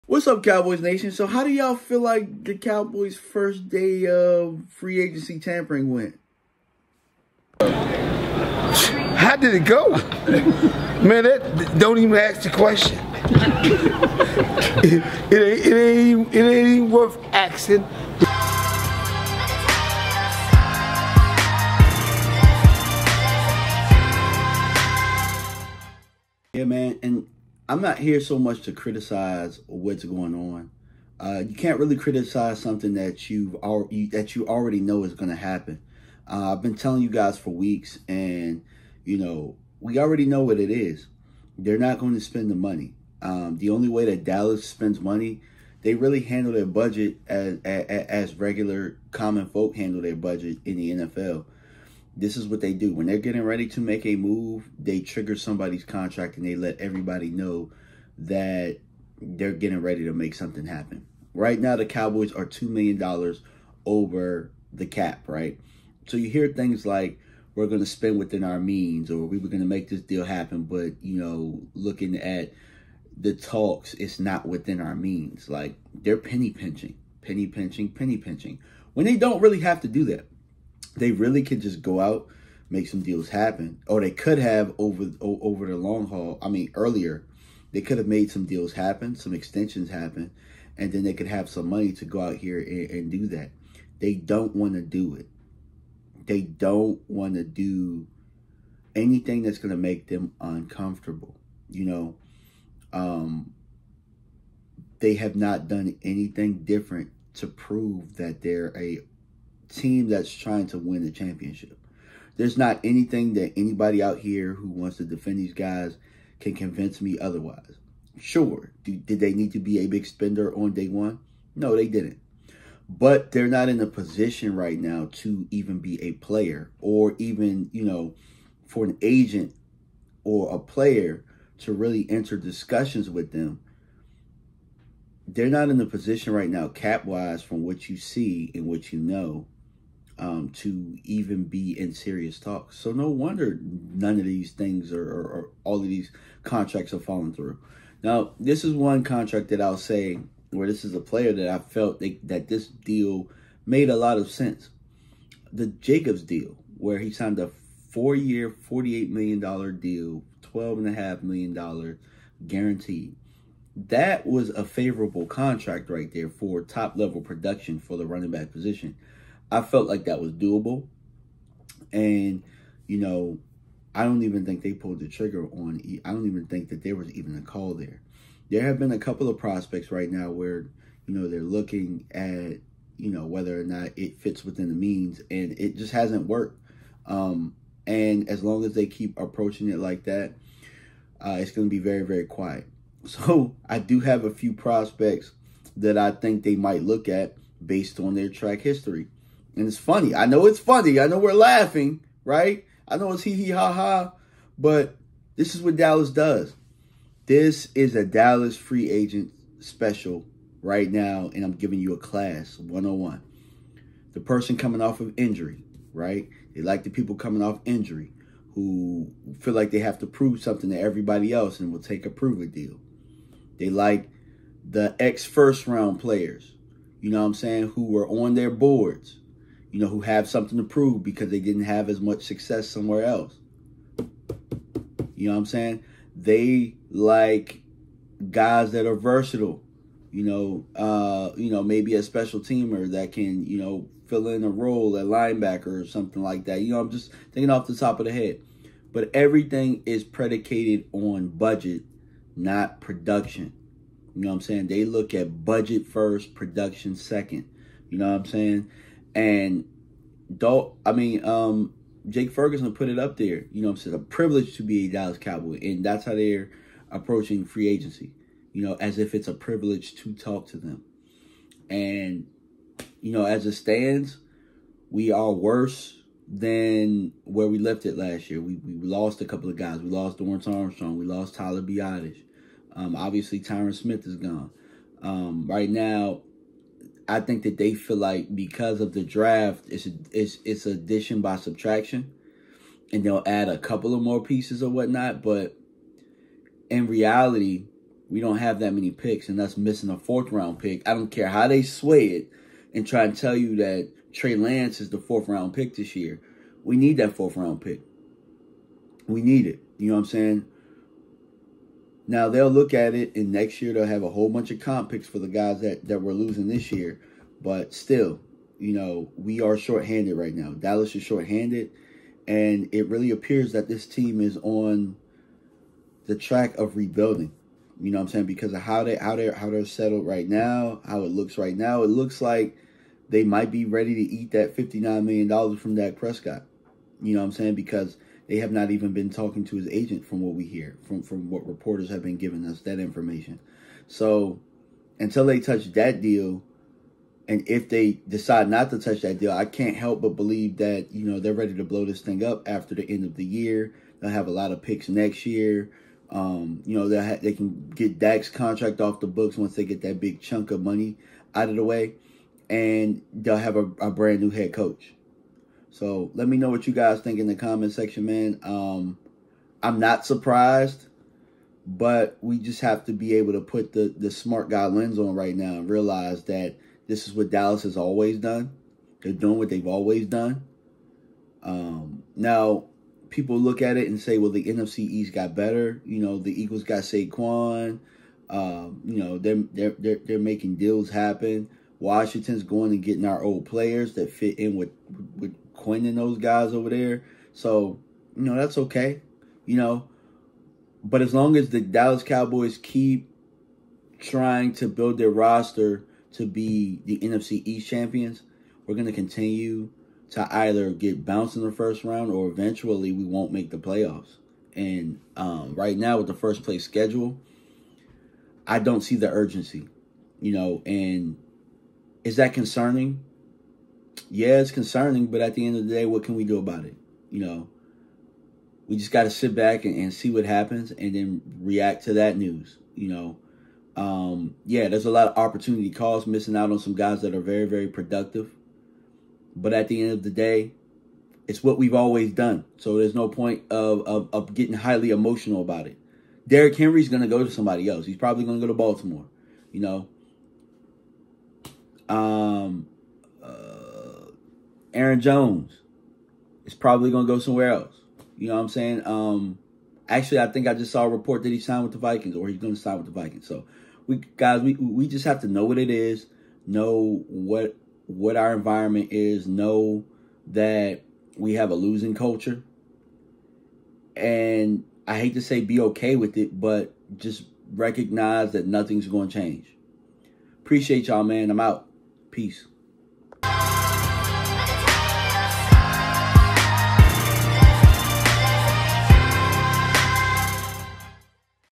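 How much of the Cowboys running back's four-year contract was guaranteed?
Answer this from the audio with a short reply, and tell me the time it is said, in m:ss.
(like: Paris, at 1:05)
$12.5 million, at 2:40.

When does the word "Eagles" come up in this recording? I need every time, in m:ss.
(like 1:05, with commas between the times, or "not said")
6:26.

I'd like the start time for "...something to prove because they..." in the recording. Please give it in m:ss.
3:50.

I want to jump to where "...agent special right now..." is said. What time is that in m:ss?
3:28.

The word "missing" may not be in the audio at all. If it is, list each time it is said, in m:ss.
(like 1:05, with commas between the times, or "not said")
4:59, 7:16.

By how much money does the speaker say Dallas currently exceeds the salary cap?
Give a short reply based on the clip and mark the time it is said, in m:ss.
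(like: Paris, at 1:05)
$2 million, at 1:02.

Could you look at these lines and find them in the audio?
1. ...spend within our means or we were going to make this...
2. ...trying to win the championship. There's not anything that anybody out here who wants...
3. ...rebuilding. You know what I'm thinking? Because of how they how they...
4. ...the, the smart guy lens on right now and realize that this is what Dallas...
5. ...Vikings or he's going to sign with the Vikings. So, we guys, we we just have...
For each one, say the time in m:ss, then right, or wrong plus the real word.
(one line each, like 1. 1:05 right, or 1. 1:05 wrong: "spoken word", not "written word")
1. 1:07 right
2. 1:50 right
3. 5:26 wrong: "saying", not "thinking"
4. 6:13 right
5. 7:41 right.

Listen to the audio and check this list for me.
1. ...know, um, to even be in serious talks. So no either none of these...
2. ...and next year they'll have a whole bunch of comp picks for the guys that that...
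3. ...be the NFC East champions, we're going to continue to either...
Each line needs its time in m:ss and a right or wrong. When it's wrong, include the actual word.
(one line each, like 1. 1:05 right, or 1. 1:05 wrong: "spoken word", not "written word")
1. 2:18 wrong: "wonder", not "either"
2. 5:13 right
3. 6:46 right.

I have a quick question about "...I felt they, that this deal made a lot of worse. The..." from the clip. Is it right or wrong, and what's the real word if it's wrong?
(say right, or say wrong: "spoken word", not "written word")
wrong: "sense", not "worse".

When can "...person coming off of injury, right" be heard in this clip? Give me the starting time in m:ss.
3:34.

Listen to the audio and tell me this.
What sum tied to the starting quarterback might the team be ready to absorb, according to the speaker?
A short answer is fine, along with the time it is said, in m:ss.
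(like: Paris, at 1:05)
$59 million, at 5:34.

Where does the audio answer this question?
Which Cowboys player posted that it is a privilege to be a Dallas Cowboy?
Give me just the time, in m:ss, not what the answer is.
4:22.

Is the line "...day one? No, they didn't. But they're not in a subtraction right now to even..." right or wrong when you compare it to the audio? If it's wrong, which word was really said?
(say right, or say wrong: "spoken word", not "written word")
wrong: "position", not "subtraction".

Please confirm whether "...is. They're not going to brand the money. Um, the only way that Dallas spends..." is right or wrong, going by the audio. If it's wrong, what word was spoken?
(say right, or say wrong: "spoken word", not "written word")
wrong: "spend", not "brand".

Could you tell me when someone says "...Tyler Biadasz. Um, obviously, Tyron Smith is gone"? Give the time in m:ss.
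4:41.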